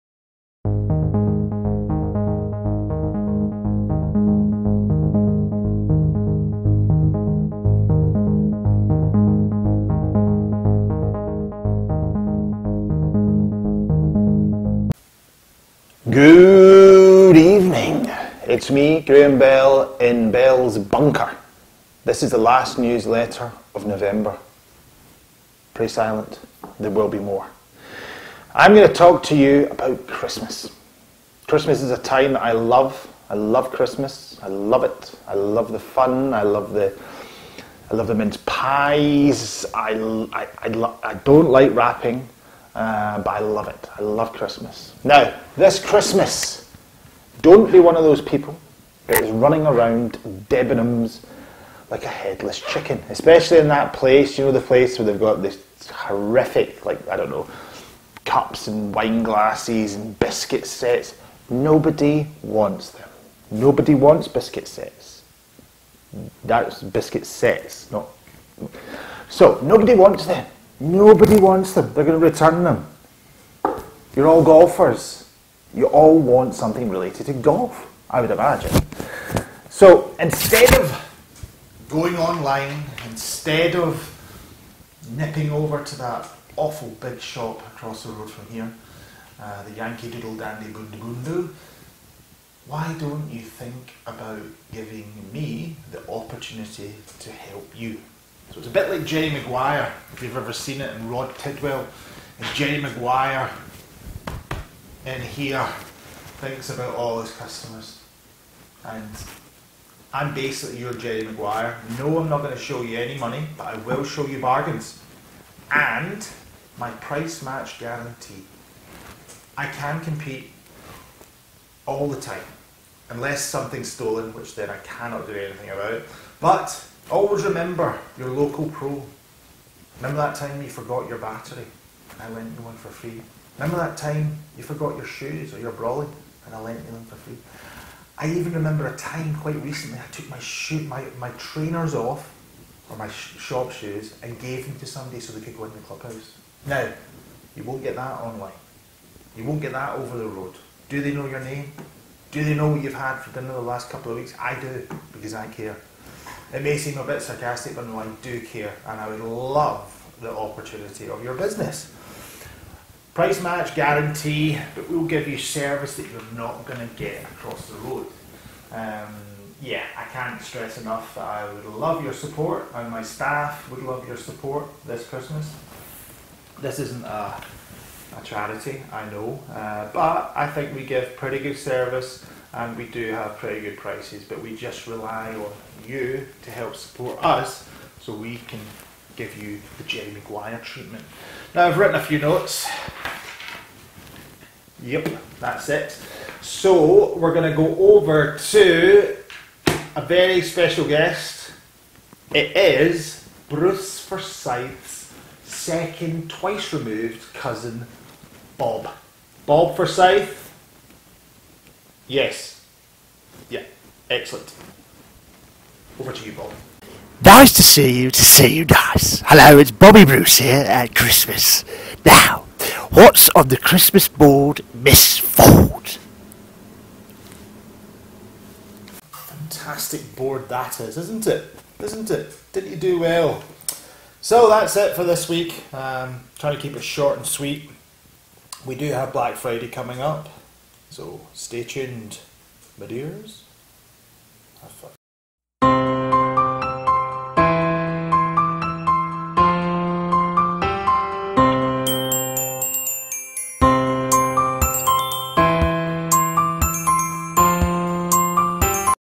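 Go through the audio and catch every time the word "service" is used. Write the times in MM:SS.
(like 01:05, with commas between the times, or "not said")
02:45, 03:01.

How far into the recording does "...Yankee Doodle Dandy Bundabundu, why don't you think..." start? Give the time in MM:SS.
01:29.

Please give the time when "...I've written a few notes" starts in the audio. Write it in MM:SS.
03:11.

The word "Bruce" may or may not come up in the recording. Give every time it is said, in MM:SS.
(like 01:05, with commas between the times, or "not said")
03:23, 03:40.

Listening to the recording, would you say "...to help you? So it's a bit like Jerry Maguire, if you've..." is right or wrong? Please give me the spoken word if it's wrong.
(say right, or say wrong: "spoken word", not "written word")
right.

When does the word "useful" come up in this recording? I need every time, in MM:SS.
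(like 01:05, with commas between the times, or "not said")
not said.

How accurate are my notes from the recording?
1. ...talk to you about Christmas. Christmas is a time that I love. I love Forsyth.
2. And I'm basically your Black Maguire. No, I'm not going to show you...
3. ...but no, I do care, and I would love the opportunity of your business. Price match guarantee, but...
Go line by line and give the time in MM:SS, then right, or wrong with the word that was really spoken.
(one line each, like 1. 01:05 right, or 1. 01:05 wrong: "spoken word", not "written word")
1. 00:28 wrong: "Christmas", not "Forsyth"
2. 01:48 wrong: "Jerry", not "Black"
3. 02:37 right.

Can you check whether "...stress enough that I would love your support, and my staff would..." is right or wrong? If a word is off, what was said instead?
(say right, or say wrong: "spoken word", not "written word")
right.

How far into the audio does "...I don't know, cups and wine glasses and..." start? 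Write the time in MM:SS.
00:57.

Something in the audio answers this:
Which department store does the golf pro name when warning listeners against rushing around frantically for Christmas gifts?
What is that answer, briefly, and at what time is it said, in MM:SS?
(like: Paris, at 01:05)
Debenhams, at 00:50.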